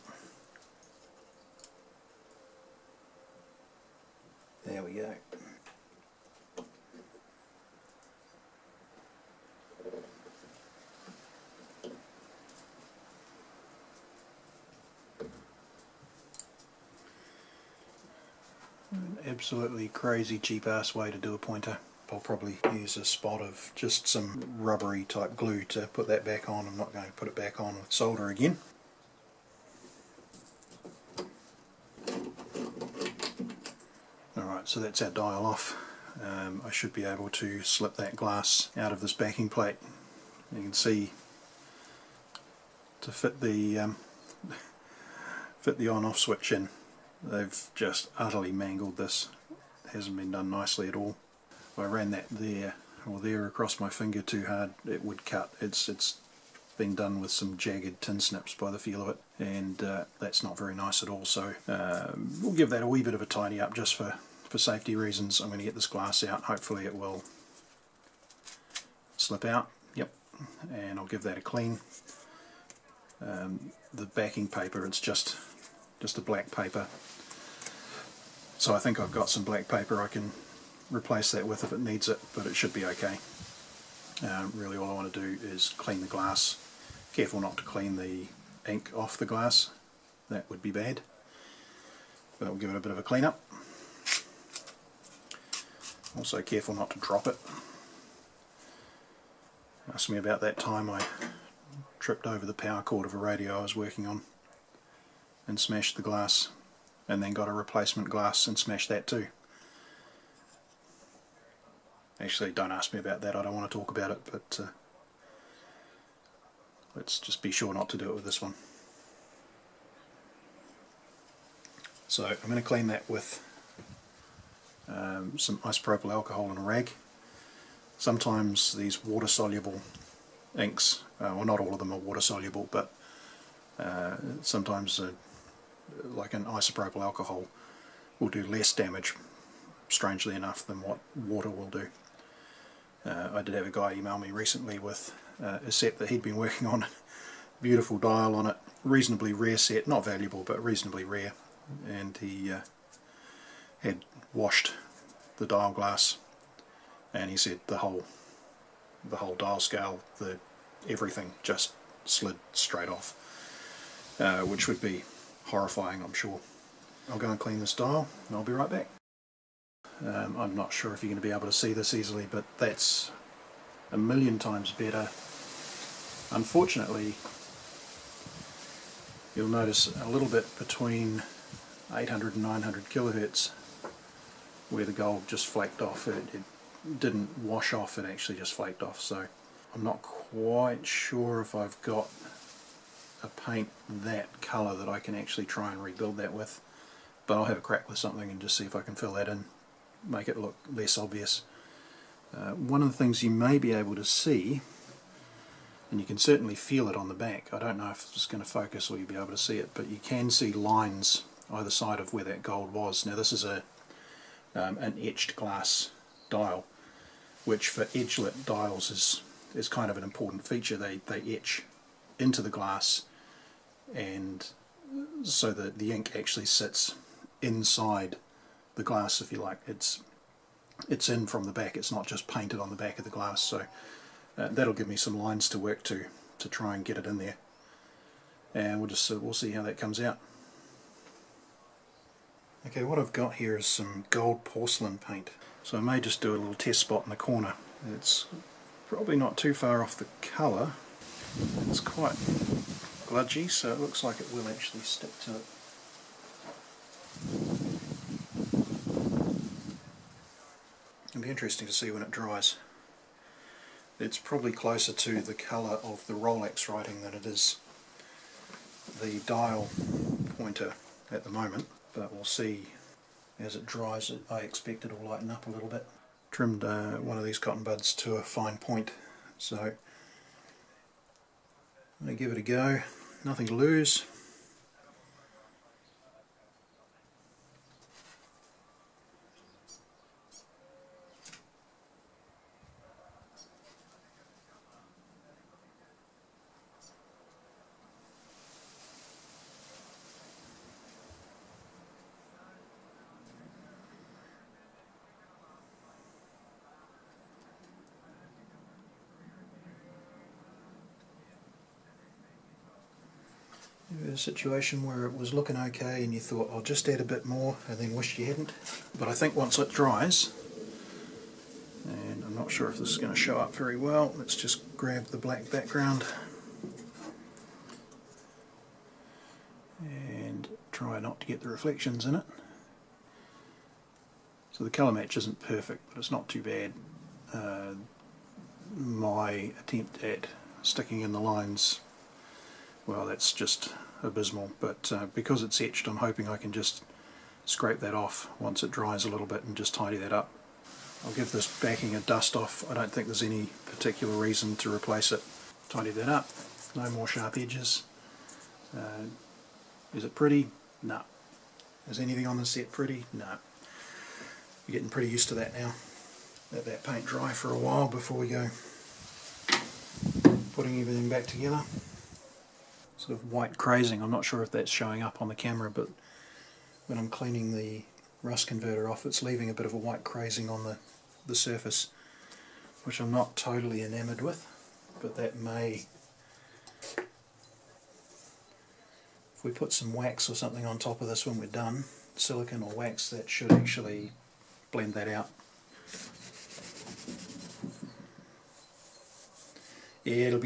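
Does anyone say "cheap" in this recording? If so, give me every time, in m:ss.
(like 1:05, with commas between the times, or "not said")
0:20.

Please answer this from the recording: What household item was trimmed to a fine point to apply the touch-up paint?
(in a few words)
Cotton buds.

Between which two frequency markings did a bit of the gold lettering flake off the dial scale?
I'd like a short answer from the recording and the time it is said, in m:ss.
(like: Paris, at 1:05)
800 and 900 kilohertz, at 3:01.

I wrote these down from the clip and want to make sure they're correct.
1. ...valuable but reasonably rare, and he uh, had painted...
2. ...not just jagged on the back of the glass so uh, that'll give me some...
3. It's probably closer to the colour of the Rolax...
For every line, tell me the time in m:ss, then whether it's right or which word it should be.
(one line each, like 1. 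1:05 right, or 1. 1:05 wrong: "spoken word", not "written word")
1. 2:30 wrong: "washed", not "painted"
2. 3:51 wrong: "painted", not "jagged"
3. 4:23 right.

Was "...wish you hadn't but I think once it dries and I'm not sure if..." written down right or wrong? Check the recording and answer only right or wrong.
right.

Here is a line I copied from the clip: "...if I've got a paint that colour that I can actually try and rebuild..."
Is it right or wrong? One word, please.
right.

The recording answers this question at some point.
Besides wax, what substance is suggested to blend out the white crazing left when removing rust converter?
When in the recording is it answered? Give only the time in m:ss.
6:32.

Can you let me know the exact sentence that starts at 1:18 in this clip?
So I think I've got some black paper I can replace that with if it needs it, but it should be okay.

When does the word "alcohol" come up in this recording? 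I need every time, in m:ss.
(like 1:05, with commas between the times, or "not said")
2:06, 2:17.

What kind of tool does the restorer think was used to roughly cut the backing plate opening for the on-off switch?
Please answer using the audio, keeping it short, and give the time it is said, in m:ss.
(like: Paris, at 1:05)
Jagged tin snips, at 0:57.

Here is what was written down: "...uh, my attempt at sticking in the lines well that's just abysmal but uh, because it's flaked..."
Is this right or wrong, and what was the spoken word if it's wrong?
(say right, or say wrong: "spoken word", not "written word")
wrong: "etched", not "flaked".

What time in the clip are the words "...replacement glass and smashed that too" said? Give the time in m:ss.
1:47.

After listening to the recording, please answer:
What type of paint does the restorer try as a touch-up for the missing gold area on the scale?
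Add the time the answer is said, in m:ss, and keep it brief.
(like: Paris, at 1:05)
Gold porcelain paint, at 4:04.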